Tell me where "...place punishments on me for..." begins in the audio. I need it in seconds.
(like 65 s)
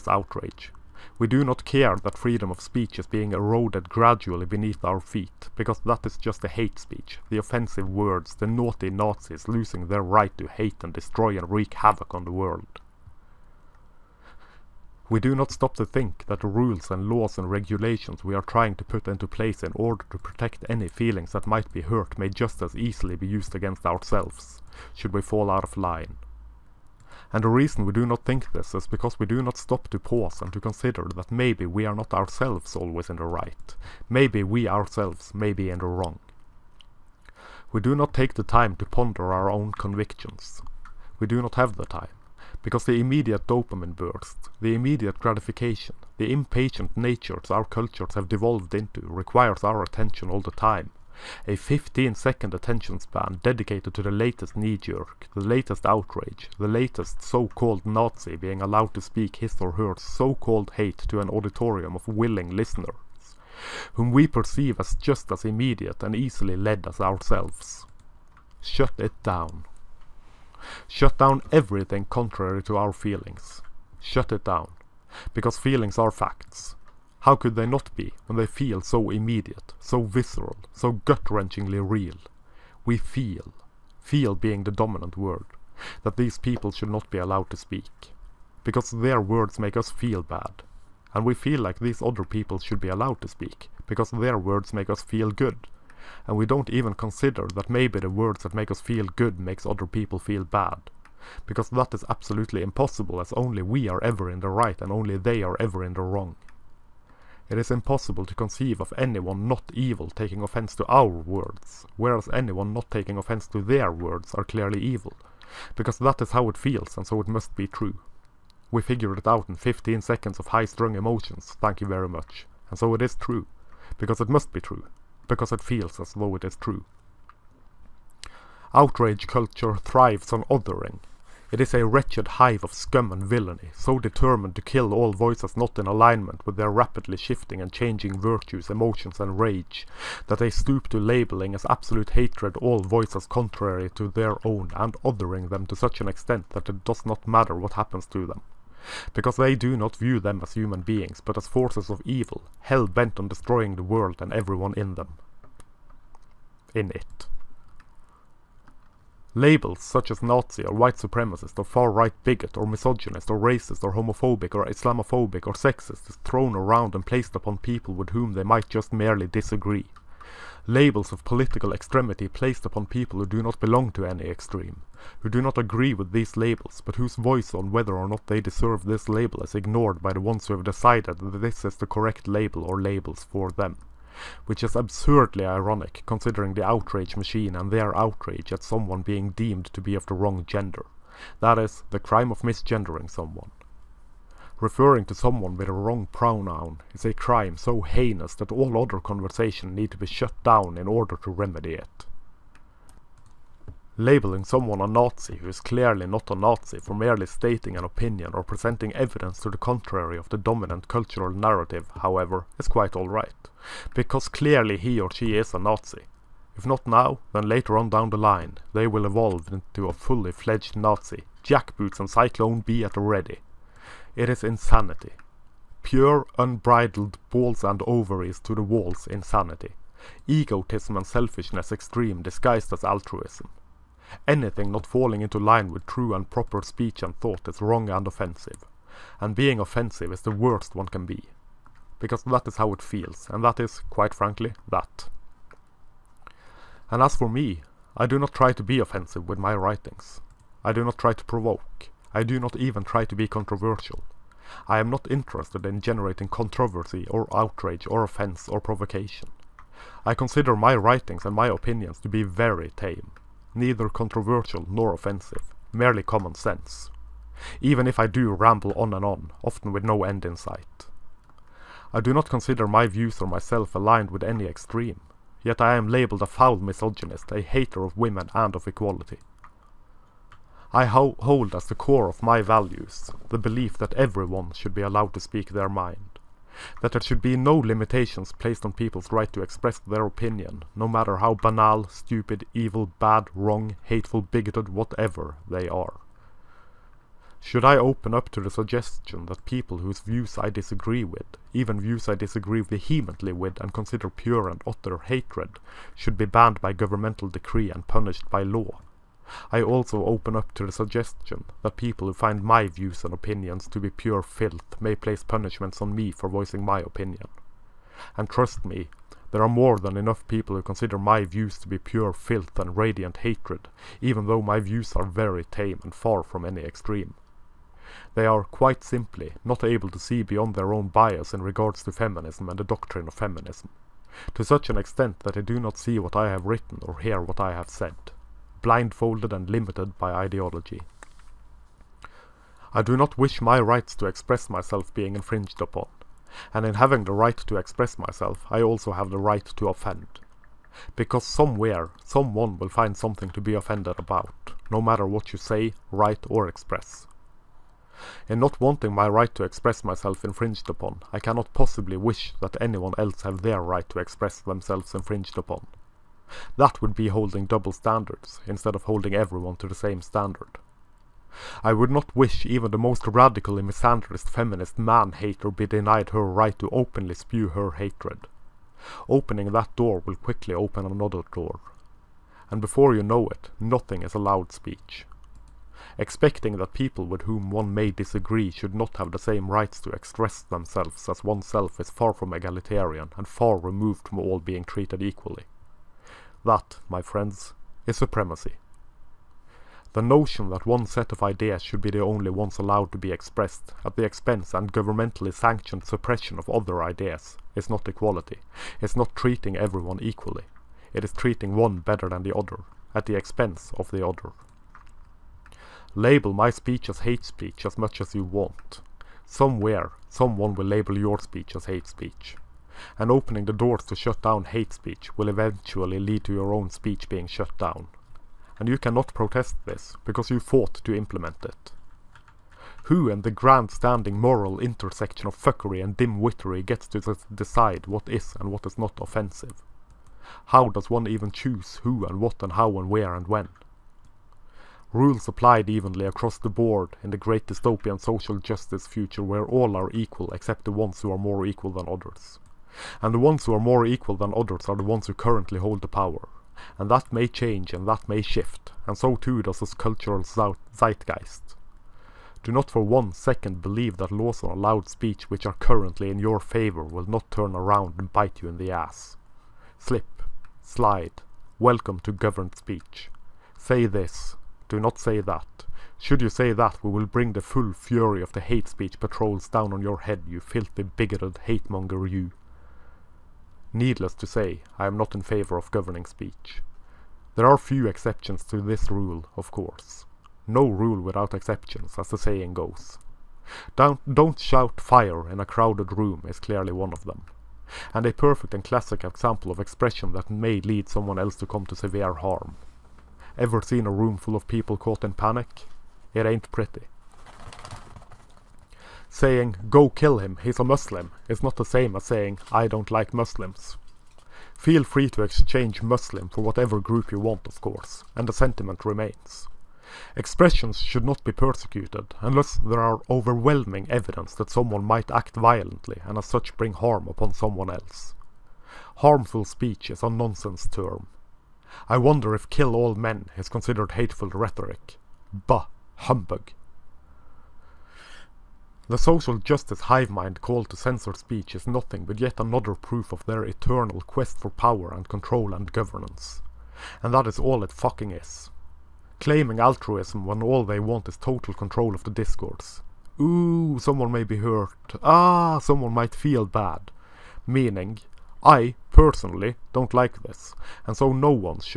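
314 s.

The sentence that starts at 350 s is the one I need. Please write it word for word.
Because somewhere, someone will find something to be offended about, no matter what you say, write or express.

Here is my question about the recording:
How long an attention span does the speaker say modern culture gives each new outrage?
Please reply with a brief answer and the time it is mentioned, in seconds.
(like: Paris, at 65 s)
15 seconds, at 51 s.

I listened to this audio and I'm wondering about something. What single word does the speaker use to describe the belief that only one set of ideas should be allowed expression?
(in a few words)
supremacy.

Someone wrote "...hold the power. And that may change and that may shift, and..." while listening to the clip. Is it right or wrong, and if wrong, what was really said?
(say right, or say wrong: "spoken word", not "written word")
right.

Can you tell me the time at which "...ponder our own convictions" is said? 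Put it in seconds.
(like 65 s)
38 s.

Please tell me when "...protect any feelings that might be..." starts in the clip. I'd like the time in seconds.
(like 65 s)
20 s.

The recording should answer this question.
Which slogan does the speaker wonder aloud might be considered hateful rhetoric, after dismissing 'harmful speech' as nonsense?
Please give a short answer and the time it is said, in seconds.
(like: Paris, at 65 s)
kill all men, at 532 s.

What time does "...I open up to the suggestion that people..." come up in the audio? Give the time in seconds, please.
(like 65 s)
297 s.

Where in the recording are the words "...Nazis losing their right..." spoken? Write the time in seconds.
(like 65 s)
8 s.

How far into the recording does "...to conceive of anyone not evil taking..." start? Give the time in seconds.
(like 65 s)
108 s.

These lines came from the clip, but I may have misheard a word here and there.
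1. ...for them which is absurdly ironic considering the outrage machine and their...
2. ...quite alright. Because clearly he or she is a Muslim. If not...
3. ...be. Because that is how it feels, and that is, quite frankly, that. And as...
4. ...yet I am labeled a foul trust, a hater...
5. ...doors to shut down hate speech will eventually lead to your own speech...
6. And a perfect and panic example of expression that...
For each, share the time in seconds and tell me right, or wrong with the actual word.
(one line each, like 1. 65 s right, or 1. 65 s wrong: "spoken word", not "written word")
1. 183 s right
2. 212 s wrong: "Nazi", not "Muslim"
3. 241 s right
4. 275 s wrong: "misogynist", not "trust"
5. 423 s right
6. 497 s wrong: "classic", not "panic".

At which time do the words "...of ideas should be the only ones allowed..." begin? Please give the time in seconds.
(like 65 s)
401 s.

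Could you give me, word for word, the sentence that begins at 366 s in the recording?
That would be holding double standards, instead of holding everyone to the same standard.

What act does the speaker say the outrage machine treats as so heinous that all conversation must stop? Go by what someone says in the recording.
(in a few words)
misgendering.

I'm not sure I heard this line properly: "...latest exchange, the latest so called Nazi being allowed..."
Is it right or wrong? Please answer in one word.
wrong.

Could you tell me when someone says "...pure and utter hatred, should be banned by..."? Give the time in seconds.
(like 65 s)
304 s.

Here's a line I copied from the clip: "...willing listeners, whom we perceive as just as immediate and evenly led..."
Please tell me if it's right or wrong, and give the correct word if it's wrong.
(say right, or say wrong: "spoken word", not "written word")
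wrong: "easily", not "evenly".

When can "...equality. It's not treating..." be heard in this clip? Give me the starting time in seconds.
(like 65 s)
407 s.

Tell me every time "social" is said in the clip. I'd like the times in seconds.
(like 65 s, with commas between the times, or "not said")
448 s, 538 s.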